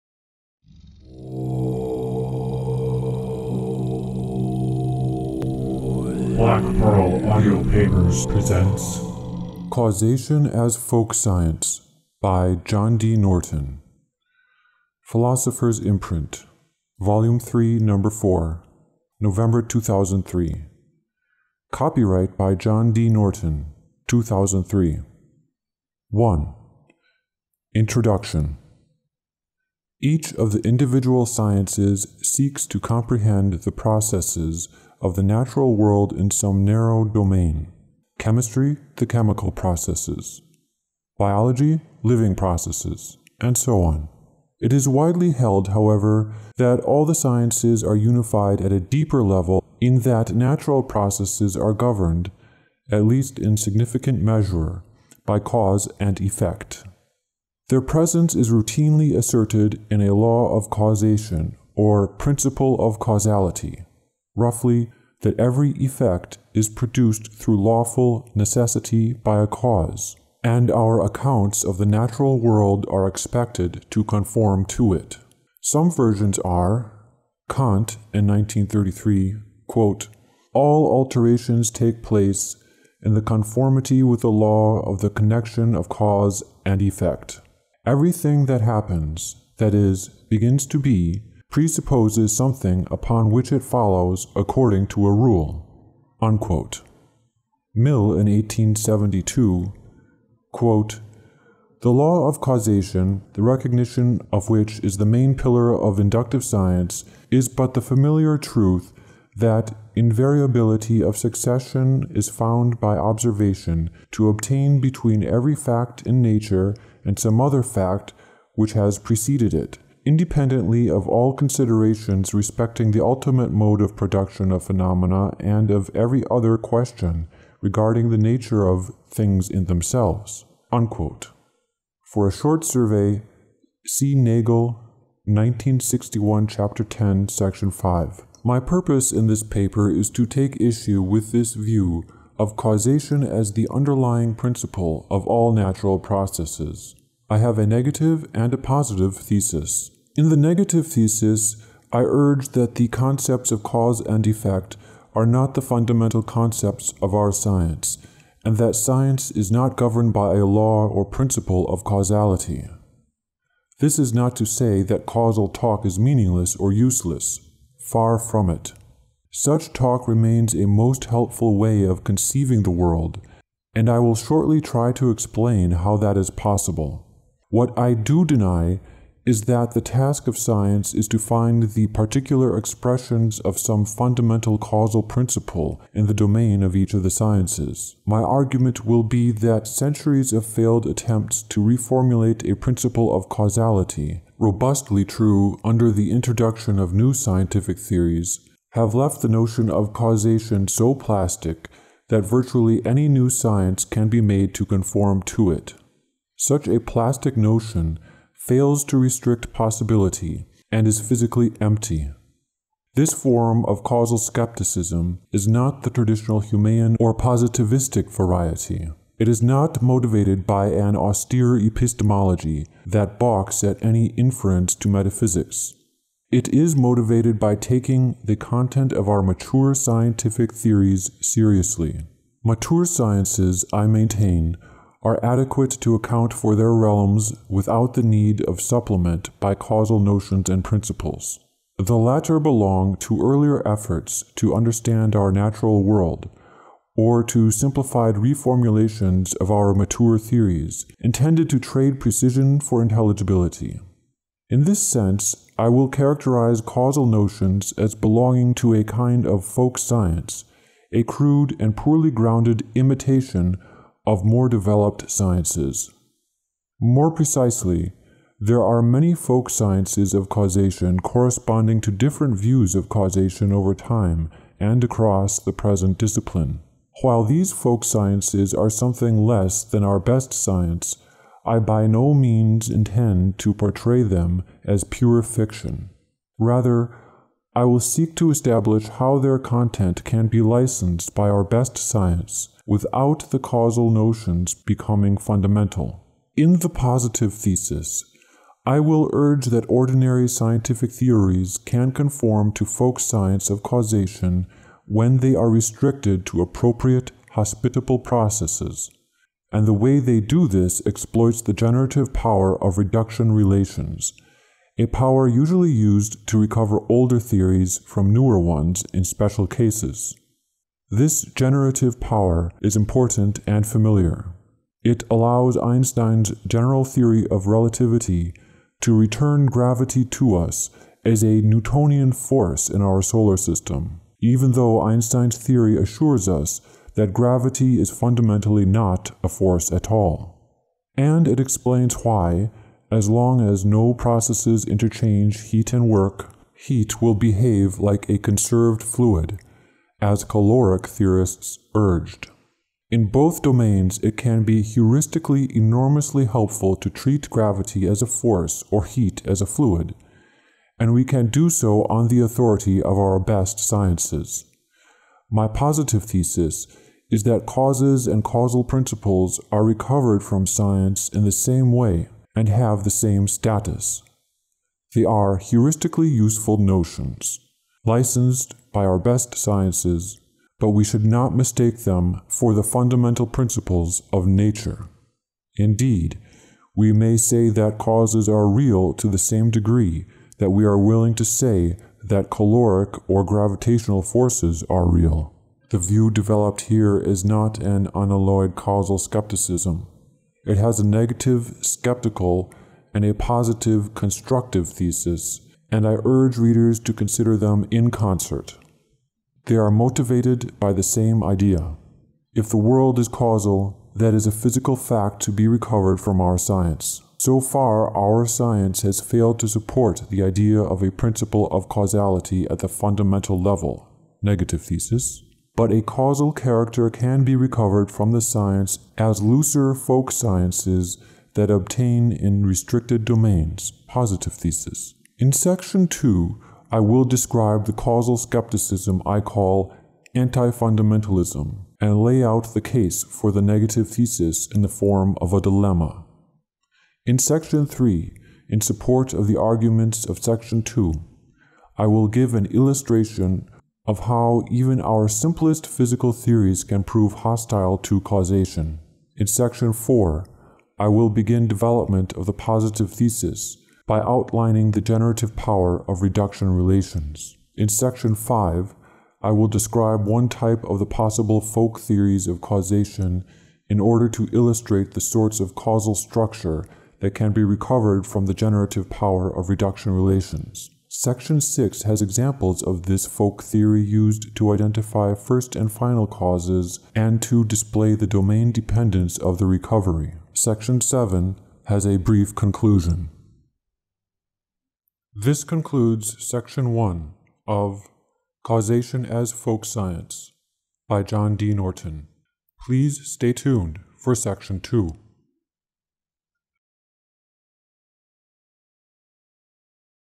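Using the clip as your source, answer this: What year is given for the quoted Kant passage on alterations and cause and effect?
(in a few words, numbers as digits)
1933.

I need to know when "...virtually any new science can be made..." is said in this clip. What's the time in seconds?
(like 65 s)
202 s.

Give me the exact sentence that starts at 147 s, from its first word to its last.
I have a negative and a positive thesis.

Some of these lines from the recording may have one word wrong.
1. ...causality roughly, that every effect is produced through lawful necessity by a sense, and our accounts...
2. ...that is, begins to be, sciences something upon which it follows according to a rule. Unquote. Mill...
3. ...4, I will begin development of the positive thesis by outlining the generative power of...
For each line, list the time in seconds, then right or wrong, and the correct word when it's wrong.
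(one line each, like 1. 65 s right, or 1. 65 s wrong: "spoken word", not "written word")
1. 62 s wrong: "cause", not "sense"
2. 89 s wrong: "presupposes", not "sciences"
3. 459 s right.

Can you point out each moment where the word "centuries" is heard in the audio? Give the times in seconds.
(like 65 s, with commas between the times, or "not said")
189 s.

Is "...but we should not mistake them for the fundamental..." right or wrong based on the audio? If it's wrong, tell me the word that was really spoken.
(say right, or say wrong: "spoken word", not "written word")
right.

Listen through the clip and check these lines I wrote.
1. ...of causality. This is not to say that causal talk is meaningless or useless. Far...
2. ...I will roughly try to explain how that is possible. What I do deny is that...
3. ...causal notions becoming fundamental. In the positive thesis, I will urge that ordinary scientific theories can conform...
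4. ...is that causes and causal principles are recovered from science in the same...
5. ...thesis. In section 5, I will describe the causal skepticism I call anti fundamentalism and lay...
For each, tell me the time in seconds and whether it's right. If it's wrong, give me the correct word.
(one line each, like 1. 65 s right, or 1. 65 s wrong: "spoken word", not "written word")
1. 161 s right
2. 173 s wrong: "shortly", not "roughly"
3. 293 s right
4. 367 s right
5. 434 s wrong: "2", not "5".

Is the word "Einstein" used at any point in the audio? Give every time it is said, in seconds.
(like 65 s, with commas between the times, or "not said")
325 s, 334 s.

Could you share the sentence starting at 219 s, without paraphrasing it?
It is not motivated by an austere epistemology that balks at any inference to metaphysics.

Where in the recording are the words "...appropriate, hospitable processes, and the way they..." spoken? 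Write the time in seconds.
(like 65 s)
306 s.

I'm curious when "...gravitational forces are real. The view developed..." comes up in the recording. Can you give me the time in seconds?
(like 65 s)
393 s.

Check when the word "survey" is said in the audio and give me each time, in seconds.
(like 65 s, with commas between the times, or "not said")
132 s.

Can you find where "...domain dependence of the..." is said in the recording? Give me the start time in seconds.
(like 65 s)
488 s.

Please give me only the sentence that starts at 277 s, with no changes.
While these folk sciences are something less than our best science, I by no means intend to portray them as pure fiction.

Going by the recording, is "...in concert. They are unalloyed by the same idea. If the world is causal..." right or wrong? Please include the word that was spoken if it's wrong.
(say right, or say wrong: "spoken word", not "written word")
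wrong: "motivated", not "unalloyed".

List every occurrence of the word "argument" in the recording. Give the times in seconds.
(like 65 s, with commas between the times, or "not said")
188 s, 449 s.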